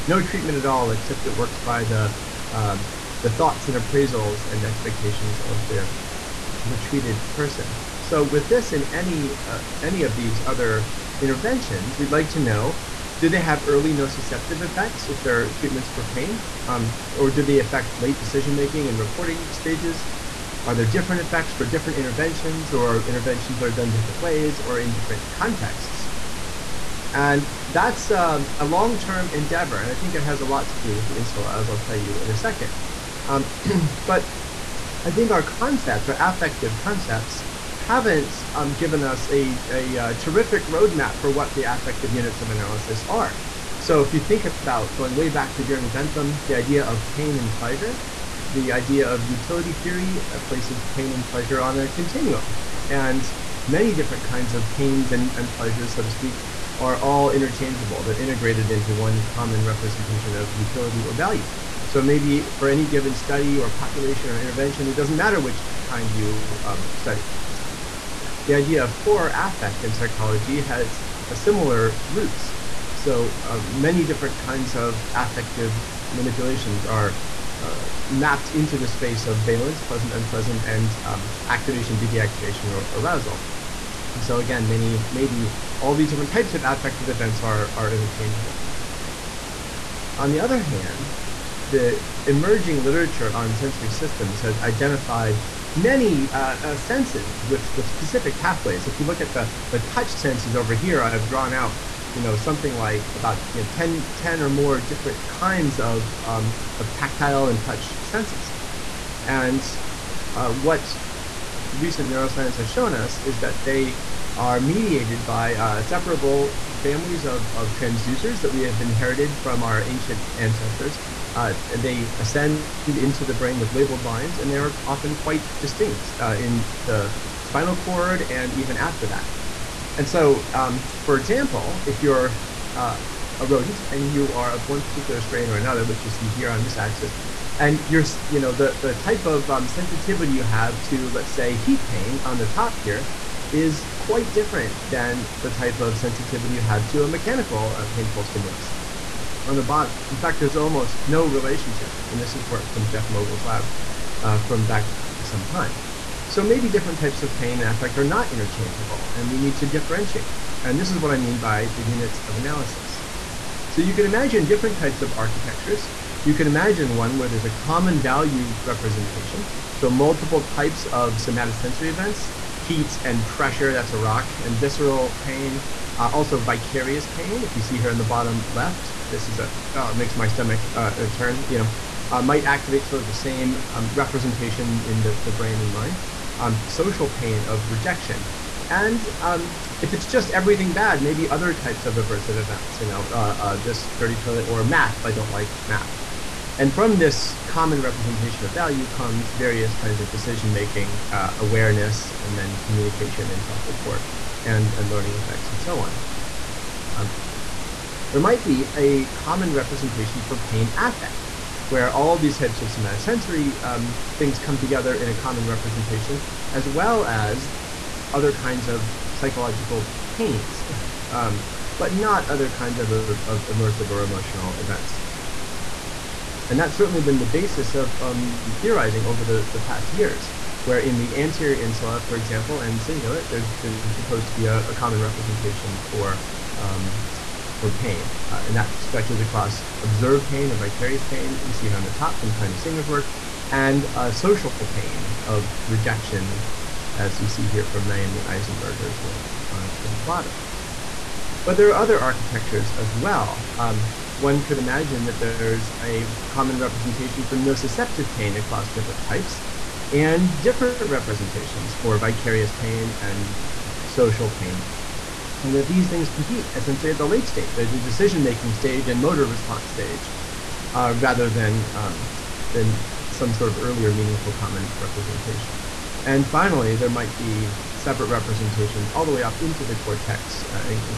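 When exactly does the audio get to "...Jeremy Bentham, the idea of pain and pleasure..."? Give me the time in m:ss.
0:45.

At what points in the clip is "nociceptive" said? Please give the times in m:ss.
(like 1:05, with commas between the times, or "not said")
0:13, 4:17.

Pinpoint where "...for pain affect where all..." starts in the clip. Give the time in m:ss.
3:30.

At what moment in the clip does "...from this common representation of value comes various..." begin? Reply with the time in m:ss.
3:16.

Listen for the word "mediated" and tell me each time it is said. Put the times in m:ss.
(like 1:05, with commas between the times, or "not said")
1:54.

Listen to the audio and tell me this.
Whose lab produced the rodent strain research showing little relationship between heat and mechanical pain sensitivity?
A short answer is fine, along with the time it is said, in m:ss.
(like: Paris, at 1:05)
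Jeff Mogil, at 2:32.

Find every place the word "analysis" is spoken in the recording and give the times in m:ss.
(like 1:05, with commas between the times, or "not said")
0:42, 2:42.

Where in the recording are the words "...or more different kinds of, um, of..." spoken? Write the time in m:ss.
1:44.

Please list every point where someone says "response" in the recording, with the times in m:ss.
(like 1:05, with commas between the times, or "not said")
4:29.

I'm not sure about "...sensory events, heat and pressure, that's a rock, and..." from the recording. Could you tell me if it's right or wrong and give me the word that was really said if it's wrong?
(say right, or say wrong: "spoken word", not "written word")
wrong: "somatosensory", not "sensory".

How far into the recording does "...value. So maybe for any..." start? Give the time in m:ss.
1:01.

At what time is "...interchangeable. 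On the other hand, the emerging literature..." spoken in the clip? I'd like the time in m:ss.
1:27.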